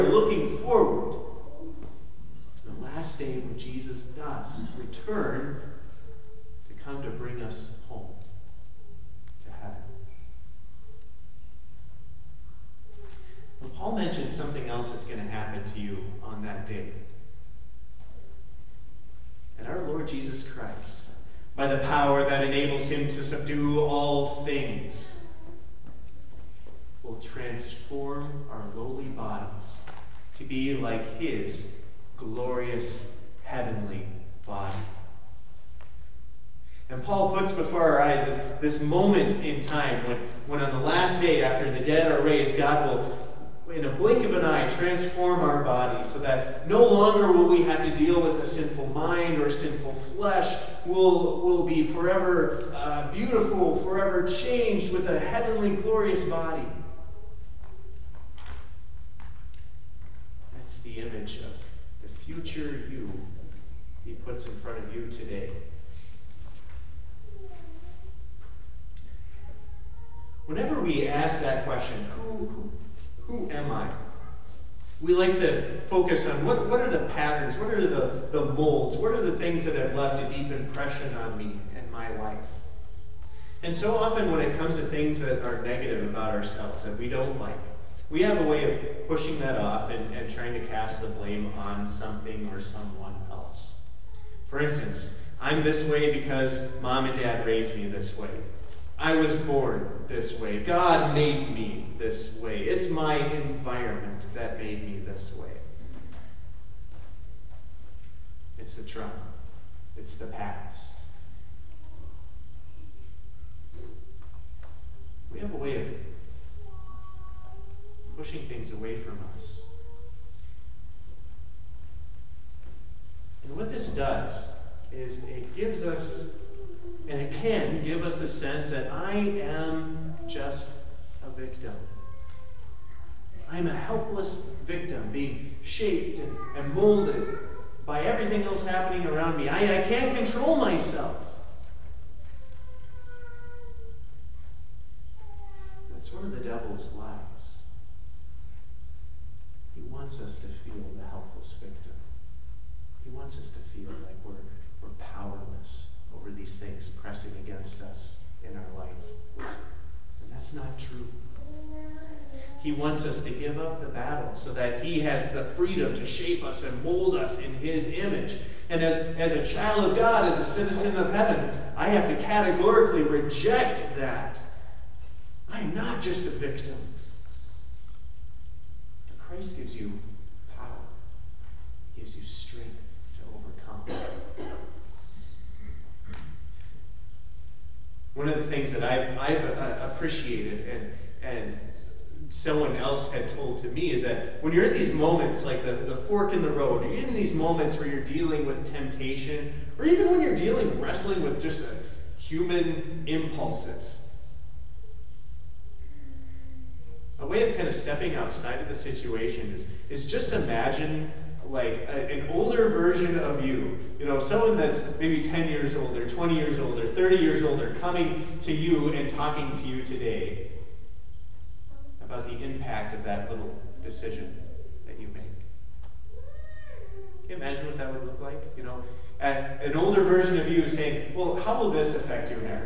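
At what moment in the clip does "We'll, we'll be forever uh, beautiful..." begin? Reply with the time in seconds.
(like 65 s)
50 s.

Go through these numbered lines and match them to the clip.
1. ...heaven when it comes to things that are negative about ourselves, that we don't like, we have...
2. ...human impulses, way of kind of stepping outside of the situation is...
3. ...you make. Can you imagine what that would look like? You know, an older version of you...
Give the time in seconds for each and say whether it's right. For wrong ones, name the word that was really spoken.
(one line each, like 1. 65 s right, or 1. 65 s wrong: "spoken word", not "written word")
1. 83 s wrong: "often", not "heaven"
2. 202 s right
3. 224 s right.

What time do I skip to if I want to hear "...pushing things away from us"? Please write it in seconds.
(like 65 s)
118 s.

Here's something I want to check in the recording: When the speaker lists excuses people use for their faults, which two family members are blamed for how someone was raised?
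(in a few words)
mom and dad.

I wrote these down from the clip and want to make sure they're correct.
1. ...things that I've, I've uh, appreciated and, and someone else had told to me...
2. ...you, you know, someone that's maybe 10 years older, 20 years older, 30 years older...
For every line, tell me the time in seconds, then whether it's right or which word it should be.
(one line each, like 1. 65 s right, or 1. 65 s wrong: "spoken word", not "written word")
1. 188 s right
2. 213 s right.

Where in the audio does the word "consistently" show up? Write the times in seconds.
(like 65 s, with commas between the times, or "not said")
not said.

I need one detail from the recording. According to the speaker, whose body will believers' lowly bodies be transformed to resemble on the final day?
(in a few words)
Jesus Christ.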